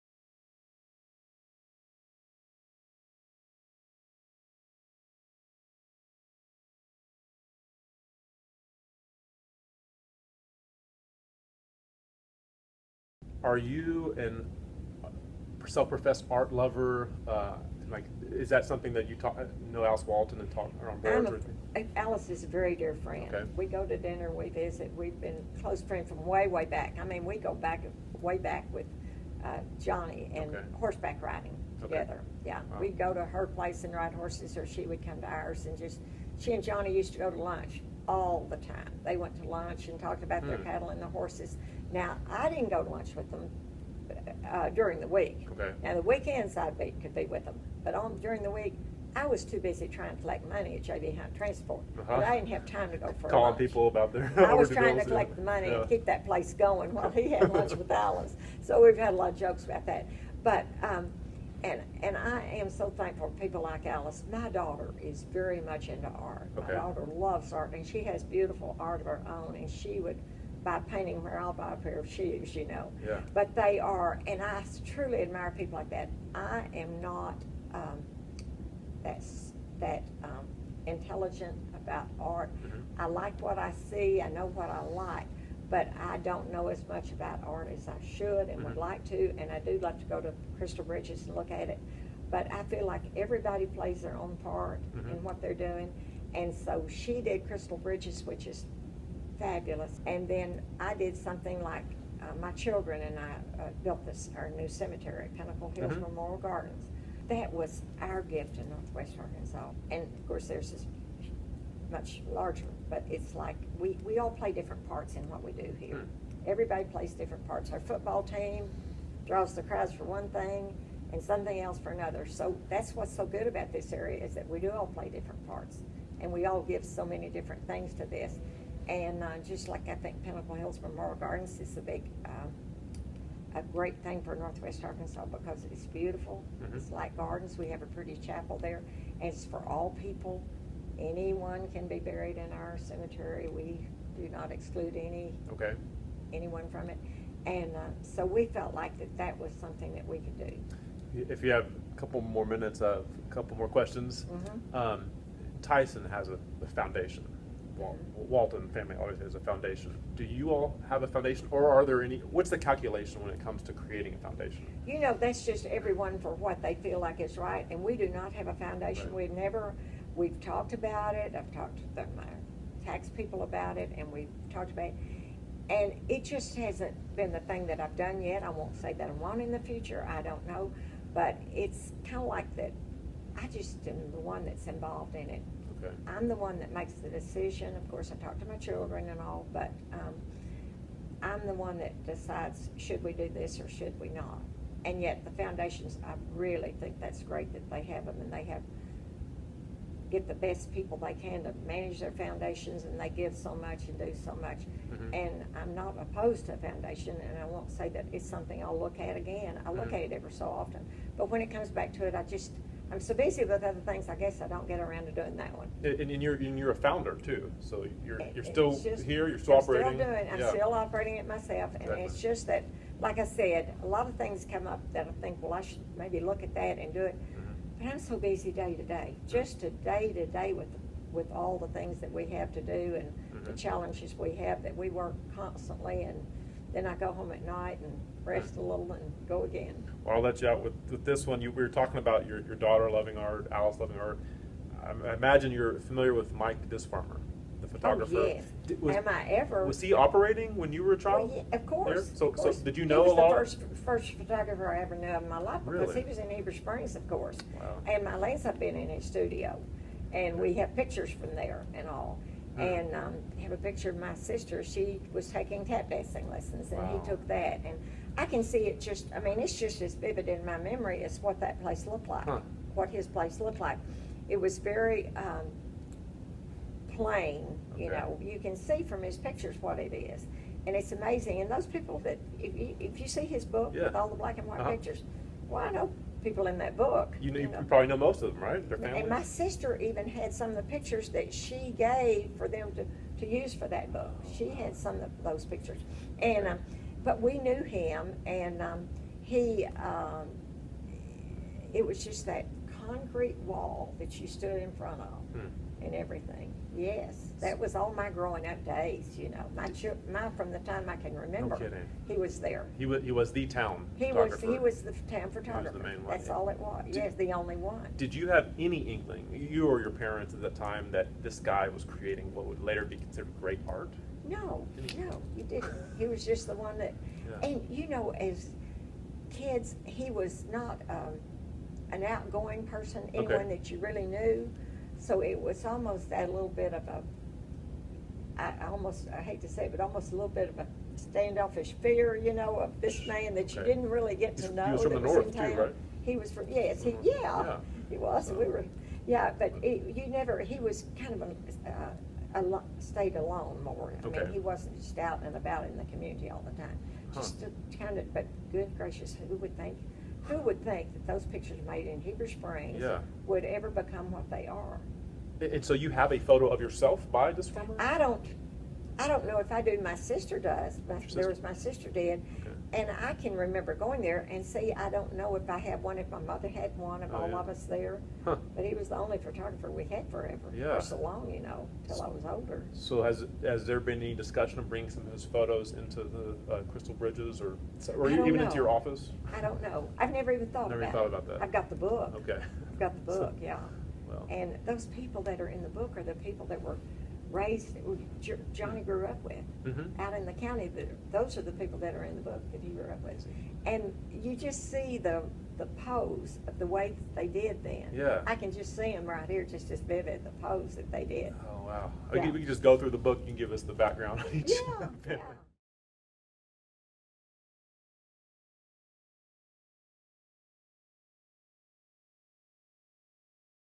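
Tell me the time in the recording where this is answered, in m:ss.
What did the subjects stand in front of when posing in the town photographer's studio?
5:02.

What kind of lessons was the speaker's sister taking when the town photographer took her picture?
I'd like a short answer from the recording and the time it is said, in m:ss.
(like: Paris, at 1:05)
tap dancing, at 4:25.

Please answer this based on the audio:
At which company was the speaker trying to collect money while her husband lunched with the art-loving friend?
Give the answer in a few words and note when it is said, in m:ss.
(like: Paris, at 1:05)
JB Hunt Transport, at 0:50.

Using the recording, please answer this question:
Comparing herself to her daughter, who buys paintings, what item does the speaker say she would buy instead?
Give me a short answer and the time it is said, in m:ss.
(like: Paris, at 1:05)
a pair of shoes, at 1:11.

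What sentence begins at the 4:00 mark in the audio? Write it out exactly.
Well, I'll let you out with, with this one.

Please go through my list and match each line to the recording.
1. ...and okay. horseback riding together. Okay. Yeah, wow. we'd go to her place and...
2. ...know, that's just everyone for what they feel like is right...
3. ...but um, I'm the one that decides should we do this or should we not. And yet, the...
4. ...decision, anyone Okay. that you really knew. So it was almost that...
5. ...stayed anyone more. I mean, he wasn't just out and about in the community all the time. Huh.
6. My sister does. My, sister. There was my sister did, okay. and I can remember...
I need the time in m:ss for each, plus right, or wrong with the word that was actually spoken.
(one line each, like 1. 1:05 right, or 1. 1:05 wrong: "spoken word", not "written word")
1. 0:30 right
2. 2:44 right
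3. 3:09 right
4. 5:32 wrong: "person", not "decision"
5. 5:52 wrong: "alone", not "anyone"
6. 6:09 right.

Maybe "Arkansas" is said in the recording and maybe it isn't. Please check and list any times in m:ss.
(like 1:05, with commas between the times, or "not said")
1:49, 2:14.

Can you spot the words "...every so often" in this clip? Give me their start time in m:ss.
3:30.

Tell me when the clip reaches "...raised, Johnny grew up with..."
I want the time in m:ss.
6:37.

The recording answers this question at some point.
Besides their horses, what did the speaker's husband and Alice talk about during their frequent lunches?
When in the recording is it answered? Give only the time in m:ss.
0:40.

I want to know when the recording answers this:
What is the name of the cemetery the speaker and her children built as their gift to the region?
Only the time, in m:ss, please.
1:45.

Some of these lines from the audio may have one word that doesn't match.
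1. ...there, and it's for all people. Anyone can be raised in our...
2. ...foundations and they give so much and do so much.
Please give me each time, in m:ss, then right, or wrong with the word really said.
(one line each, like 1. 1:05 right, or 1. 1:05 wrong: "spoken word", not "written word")
1. 2:18 wrong: "buried", not "raised"
2. 3:22 right.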